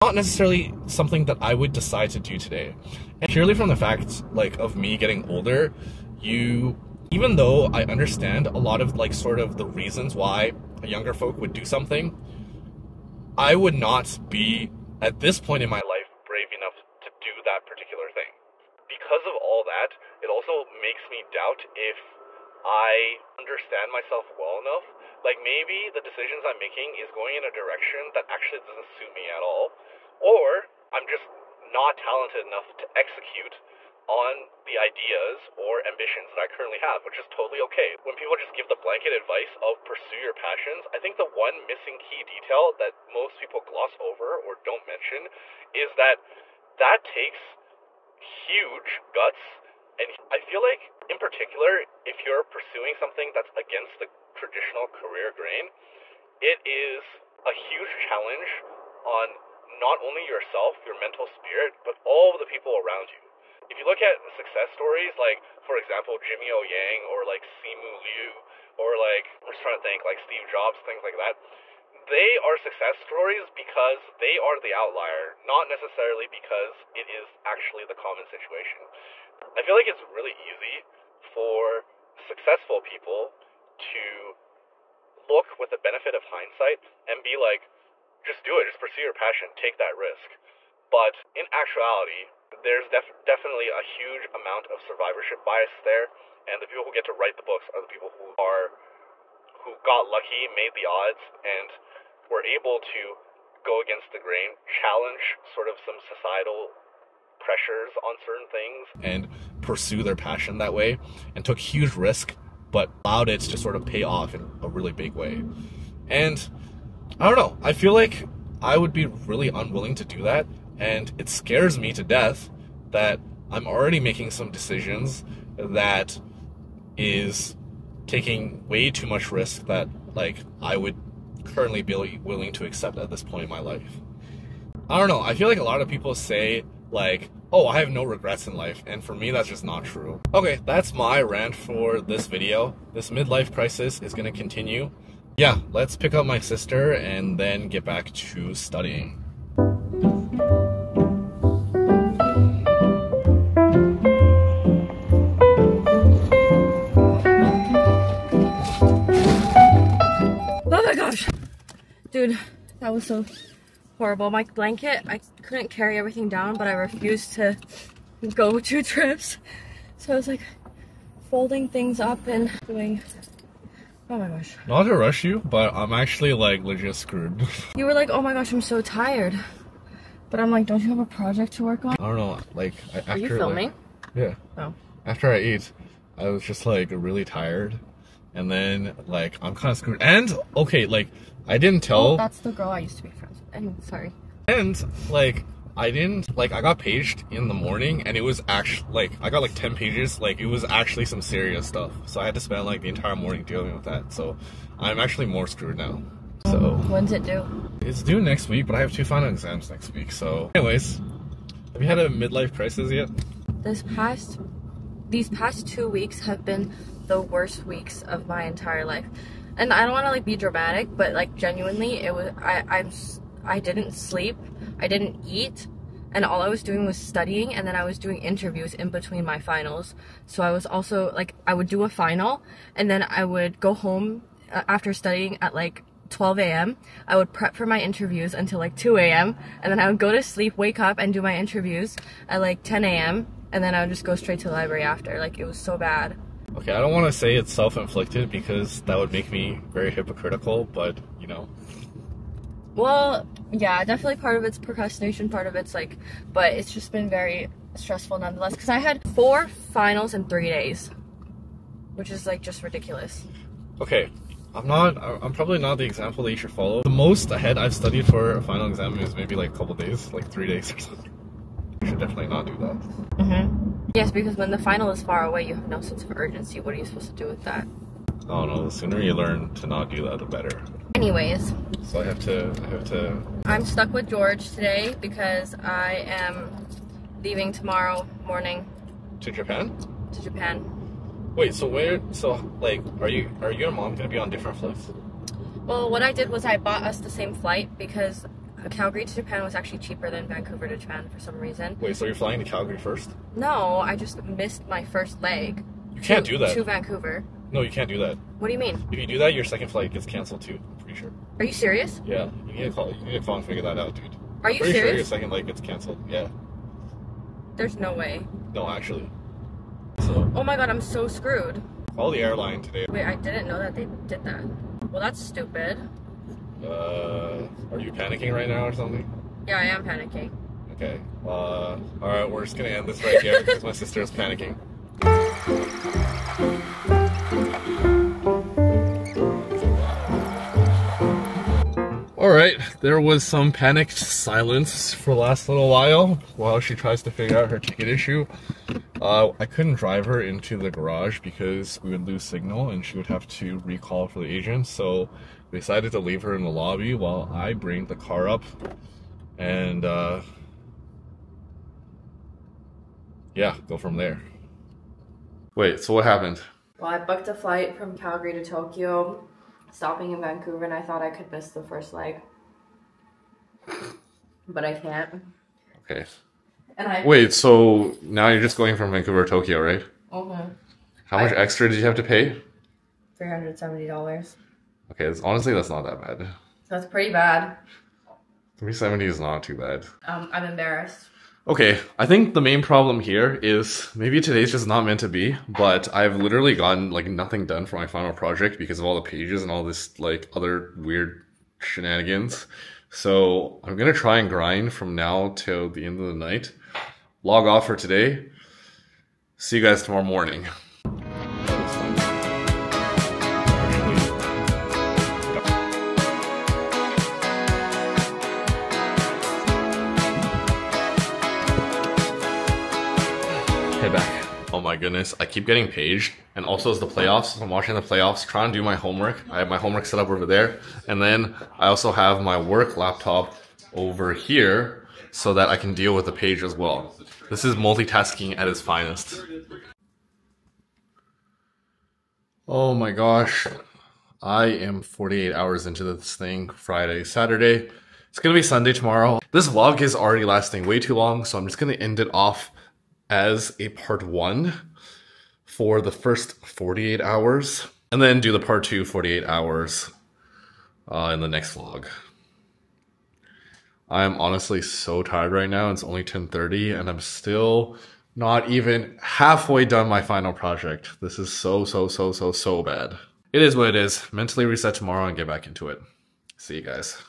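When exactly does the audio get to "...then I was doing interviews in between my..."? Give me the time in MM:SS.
03:47.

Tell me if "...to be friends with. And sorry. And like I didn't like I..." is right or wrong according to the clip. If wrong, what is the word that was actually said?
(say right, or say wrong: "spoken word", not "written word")
right.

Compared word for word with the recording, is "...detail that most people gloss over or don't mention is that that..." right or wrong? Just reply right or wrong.
right.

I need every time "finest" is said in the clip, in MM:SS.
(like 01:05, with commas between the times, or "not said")
07:18.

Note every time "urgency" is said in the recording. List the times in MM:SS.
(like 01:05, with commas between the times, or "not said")
04:36.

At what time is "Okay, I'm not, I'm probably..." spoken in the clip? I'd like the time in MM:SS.
04:23.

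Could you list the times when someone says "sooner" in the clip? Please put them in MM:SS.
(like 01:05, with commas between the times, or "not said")
04:38.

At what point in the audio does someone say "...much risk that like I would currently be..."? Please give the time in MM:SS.
02:09.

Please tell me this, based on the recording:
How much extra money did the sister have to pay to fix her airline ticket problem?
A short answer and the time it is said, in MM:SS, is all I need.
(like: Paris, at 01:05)
$370, at 06:23.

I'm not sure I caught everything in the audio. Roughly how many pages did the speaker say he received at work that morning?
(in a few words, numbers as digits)
10.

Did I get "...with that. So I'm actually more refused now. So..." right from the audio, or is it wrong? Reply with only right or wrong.
wrong.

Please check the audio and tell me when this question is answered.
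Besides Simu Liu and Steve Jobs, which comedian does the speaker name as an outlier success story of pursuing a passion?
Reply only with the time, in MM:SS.
01:06.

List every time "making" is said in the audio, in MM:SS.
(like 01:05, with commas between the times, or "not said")
00:26, 02:04.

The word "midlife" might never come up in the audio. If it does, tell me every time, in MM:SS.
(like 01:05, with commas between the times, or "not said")
02:23, 03:32.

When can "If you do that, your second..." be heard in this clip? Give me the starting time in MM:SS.
05:08.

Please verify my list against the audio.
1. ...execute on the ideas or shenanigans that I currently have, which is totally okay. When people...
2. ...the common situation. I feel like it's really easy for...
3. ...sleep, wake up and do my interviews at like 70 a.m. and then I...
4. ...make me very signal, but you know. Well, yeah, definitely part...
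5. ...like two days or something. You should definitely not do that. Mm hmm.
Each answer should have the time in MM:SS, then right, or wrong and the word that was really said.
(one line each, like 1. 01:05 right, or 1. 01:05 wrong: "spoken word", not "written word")
1. 00:32 wrong: "ambitions", not "shenanigans"
2. 01:17 right
3. 04:00 wrong: "10", not "70"
4. 04:09 wrong: "hypocritical", not "signal"
5. 04:30 wrong: "three", not "two".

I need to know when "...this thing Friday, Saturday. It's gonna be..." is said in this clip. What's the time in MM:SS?
07:25.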